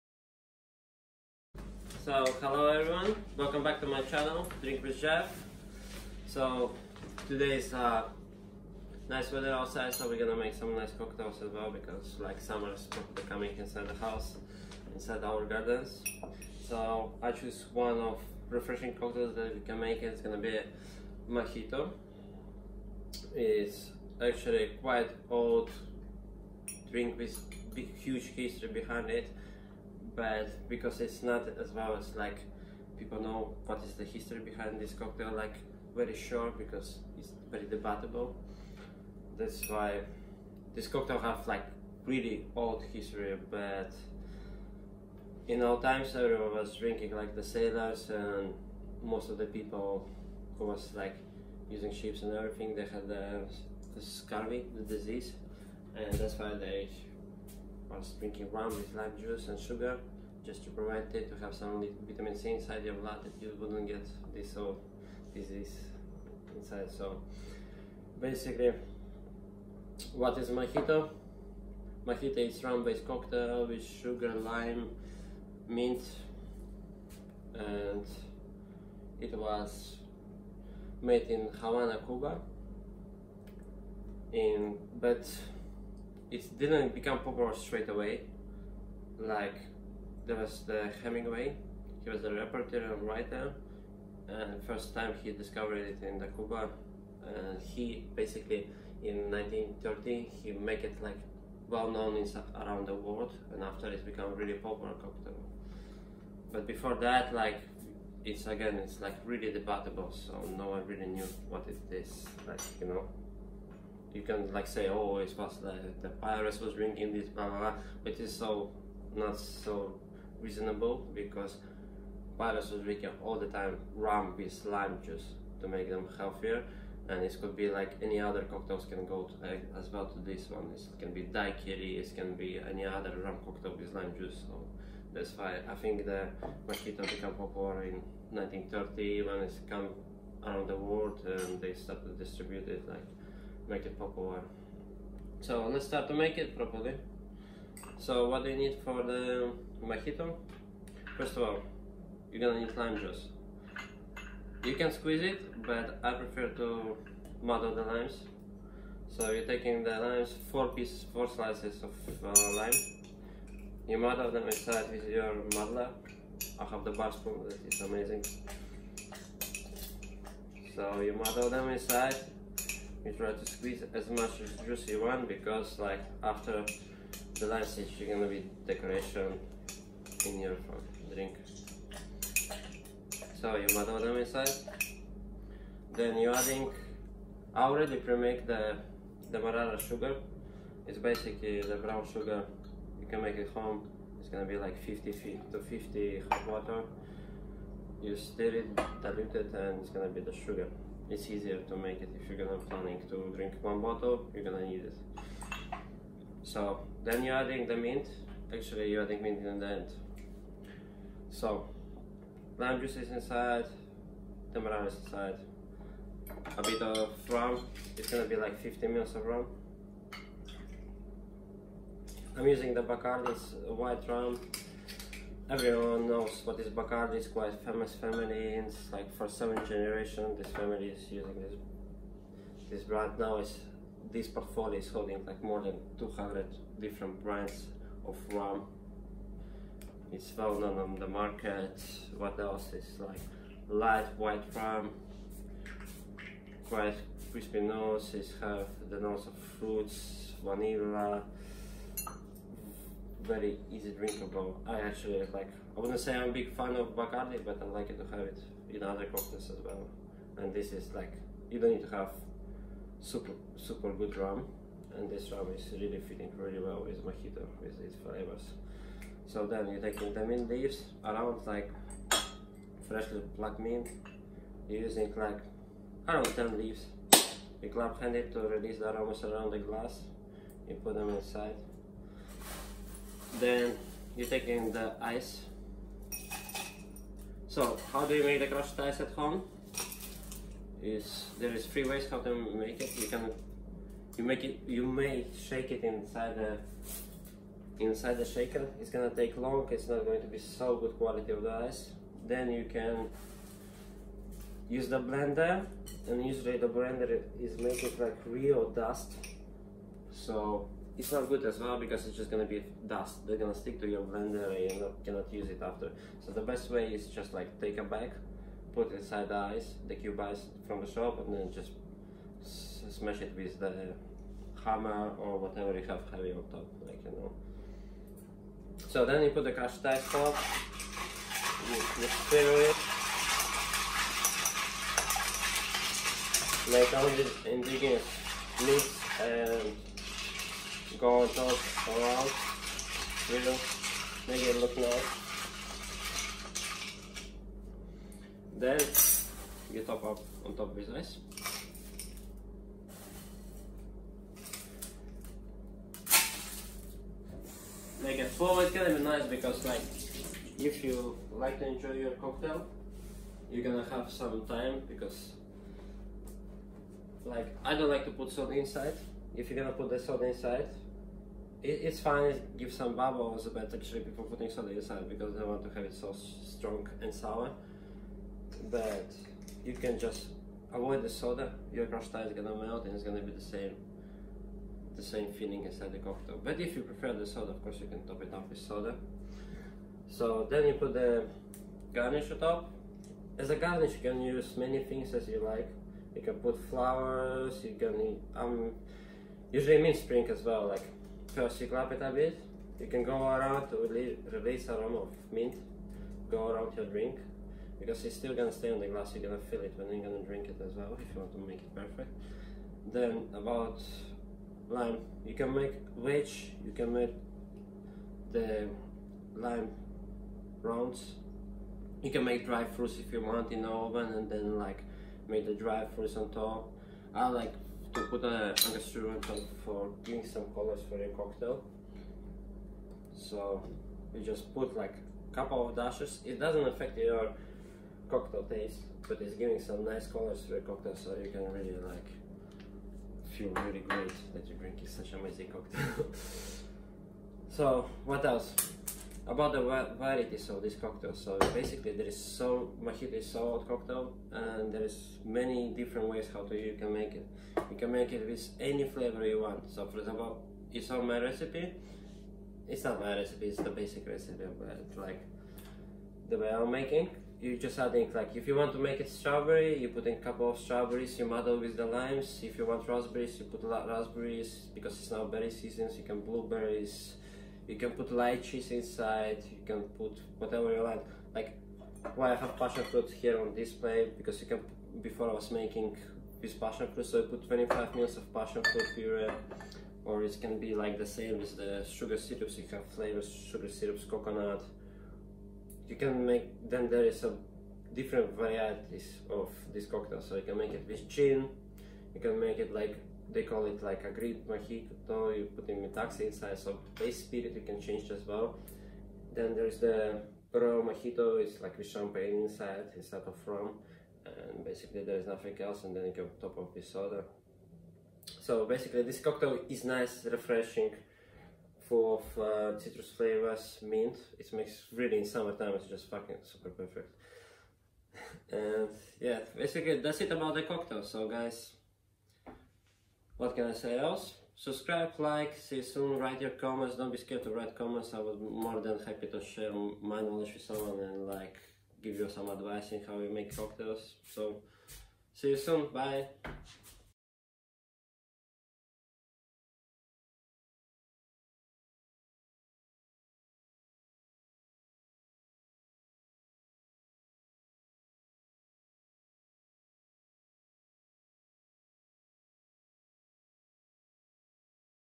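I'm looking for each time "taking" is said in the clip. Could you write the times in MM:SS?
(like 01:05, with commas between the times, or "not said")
02:39, 04:44.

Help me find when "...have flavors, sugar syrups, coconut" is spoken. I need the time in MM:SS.
08:12.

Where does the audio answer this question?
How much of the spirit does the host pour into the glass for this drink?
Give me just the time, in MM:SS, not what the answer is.
03:38.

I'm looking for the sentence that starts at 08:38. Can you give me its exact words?
So basically this cocktail is nice, refreshing, full of uh, citrus flavors, mint.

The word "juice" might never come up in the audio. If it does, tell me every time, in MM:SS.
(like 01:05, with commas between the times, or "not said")
00:59, 02:05, 02:14, 02:32, 02:54, 03:32.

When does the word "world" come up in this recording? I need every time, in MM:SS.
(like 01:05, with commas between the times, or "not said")
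01:42, 02:20.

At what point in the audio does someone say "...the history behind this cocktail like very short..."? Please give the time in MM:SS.
00:33.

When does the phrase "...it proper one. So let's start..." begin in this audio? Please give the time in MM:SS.
02:23.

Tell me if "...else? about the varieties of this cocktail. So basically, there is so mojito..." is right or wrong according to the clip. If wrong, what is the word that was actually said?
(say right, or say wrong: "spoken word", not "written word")
right.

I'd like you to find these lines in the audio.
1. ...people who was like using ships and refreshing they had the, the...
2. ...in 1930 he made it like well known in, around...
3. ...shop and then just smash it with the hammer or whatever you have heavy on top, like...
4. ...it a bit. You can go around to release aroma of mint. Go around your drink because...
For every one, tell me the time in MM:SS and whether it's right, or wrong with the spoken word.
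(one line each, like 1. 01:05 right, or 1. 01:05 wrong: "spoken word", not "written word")
1. 00:49 wrong: "everything", not "refreshing"
2. 01:39 right
3. 05:20 right
4. 06:41 right.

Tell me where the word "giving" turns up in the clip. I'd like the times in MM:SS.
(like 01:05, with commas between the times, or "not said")
07:10, 07:19.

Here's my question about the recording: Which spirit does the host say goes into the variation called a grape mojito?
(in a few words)
Metaxa.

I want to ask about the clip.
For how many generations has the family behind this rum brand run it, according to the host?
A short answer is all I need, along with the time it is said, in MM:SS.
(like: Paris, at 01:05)
7, at 03:49.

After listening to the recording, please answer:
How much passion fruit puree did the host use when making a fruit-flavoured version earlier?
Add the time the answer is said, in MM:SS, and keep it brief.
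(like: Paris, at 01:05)
25 ml, at 08:07.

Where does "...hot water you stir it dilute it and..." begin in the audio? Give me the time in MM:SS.
03:16.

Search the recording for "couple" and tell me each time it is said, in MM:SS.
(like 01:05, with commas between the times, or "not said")
07:15, 07:50.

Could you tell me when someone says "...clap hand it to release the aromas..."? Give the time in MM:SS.
04:37.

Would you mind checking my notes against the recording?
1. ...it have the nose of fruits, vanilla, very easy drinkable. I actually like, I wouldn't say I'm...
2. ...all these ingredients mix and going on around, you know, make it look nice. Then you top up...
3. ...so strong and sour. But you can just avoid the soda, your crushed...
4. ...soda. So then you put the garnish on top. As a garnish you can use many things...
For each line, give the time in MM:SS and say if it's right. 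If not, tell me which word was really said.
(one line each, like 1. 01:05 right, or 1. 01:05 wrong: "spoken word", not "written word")
1. 04:08 right
2. 05:36 right
3. 06:15 right
4. 06:28 right.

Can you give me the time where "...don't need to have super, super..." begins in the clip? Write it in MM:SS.
04:21.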